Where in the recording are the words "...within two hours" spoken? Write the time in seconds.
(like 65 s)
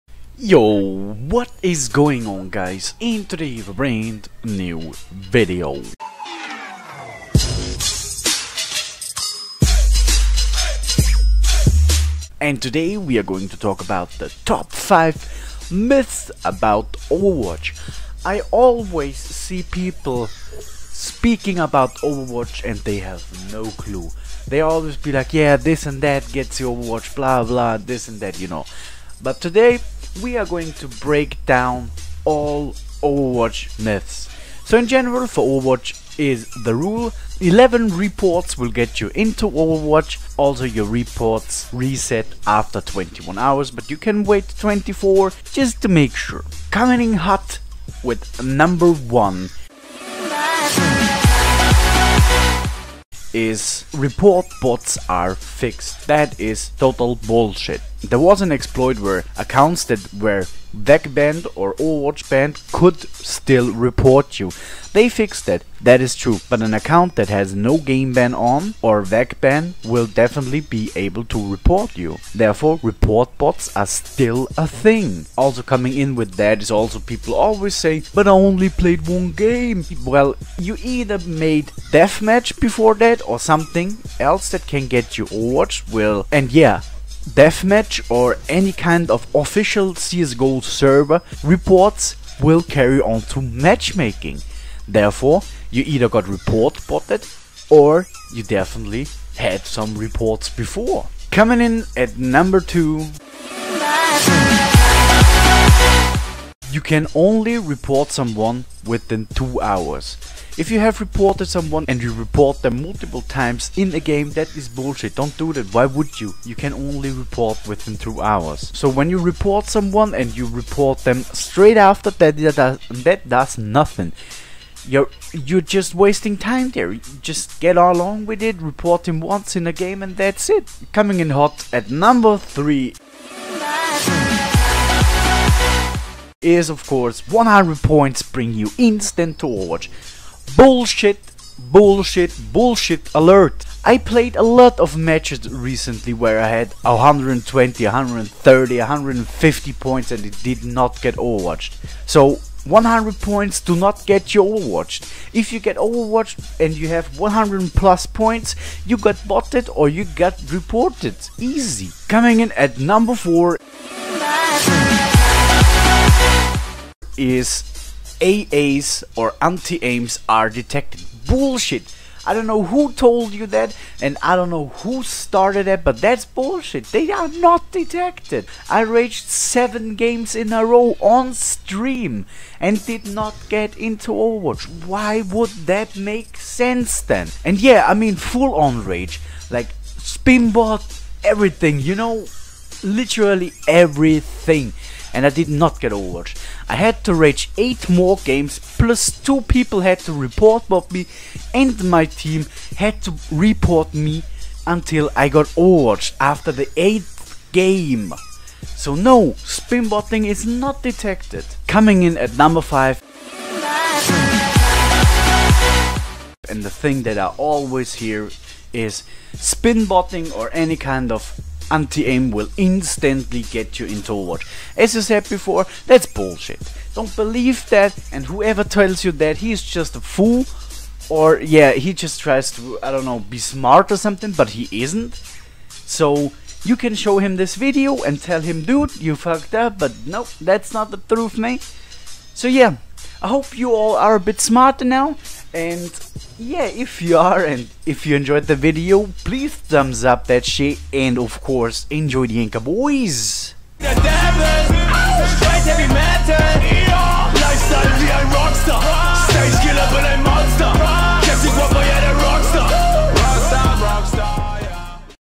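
117 s.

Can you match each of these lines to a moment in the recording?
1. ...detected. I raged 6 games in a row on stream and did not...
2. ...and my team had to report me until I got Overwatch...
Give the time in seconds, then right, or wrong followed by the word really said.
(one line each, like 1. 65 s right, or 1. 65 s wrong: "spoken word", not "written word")
1. 177 s wrong: "7", not "6"
2. 201 s right.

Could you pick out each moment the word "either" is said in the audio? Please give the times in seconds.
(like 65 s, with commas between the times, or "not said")
80 s, 95 s.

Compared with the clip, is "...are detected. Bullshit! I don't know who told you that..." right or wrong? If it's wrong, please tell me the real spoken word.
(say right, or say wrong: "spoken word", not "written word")
right.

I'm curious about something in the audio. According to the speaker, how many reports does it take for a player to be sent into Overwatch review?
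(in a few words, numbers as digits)
11.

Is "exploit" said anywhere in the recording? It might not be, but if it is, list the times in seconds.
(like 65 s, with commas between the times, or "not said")
58 s.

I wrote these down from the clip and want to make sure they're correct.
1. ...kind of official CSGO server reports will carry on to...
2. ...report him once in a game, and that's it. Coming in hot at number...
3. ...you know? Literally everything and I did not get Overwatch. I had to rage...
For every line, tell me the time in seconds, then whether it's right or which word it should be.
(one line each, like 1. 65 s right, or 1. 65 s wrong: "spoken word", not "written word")
1. 88 s right
2. 128 s right
3. 191 s right.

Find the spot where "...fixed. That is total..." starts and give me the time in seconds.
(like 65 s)
55 s.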